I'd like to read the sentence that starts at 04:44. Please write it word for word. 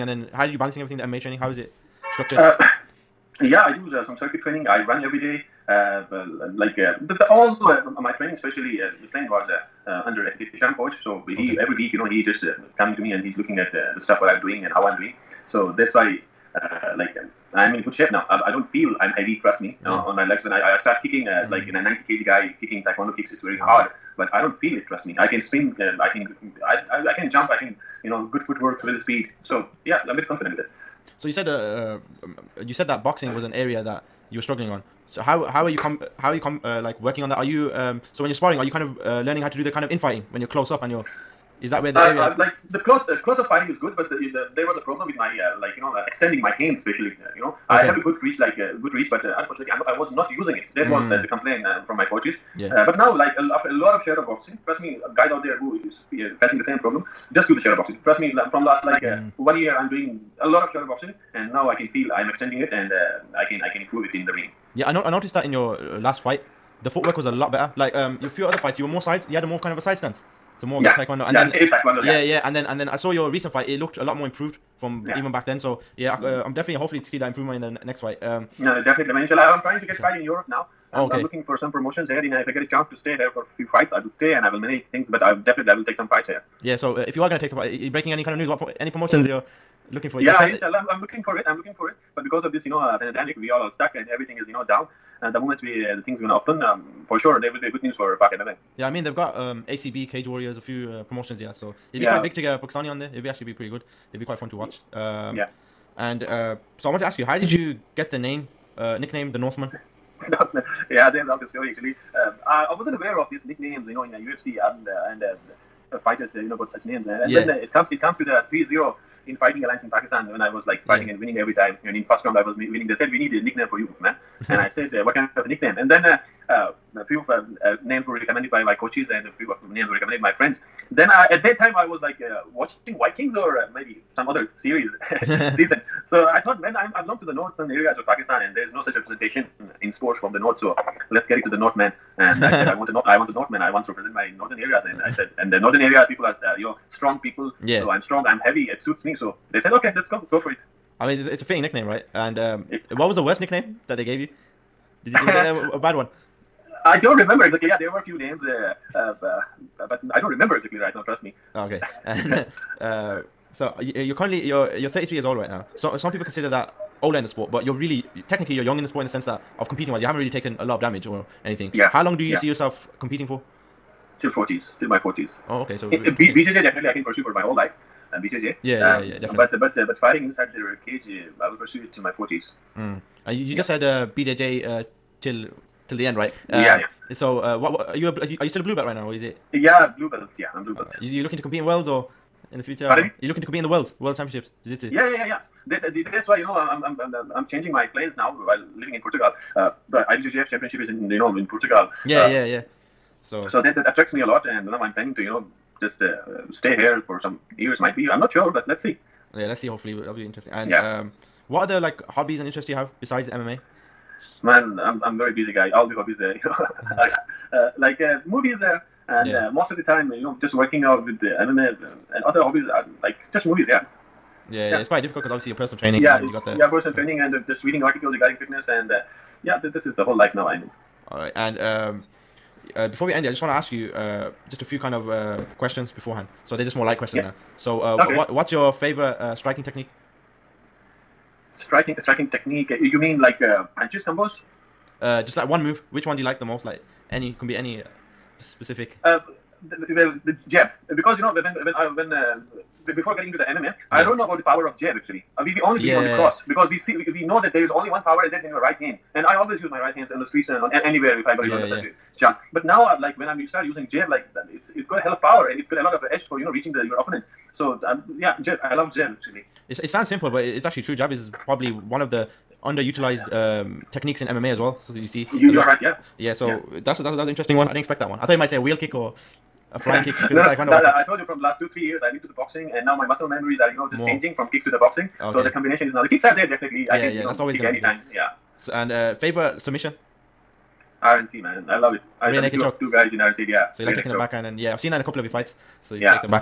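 changing from kicks to the boxing.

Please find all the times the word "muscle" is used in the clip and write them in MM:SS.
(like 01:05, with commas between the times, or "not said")
04:43.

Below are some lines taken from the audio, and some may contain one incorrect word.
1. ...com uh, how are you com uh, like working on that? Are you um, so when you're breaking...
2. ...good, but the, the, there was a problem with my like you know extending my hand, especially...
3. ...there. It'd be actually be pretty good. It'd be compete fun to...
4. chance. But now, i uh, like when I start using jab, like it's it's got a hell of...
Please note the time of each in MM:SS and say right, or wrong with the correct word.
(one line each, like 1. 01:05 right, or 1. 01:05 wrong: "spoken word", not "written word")
1. 00:35 wrong: "sparring", not "breaking"
2. 00:43 right
3. 01:42 wrong: "quite", not "compete"
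4. 04:22 right.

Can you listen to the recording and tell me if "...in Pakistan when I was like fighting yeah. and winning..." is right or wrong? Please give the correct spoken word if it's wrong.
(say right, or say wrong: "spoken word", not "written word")
right.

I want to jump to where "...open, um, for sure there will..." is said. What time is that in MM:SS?
01:36.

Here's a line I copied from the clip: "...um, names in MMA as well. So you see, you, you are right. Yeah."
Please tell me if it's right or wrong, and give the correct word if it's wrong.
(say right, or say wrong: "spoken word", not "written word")
wrong: "techniques", not "names".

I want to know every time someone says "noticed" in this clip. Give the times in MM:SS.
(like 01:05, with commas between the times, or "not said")
01:05.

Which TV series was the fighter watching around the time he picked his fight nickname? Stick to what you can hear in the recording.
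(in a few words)
Vikings.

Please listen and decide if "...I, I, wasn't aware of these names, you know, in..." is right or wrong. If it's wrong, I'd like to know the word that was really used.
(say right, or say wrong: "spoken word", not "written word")
wrong: "nicknames", not "names".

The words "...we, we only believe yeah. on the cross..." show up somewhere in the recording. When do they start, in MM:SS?
04:15.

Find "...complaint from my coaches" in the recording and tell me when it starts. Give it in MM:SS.
00:51.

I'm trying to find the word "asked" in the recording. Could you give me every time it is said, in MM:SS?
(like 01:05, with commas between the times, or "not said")
not said.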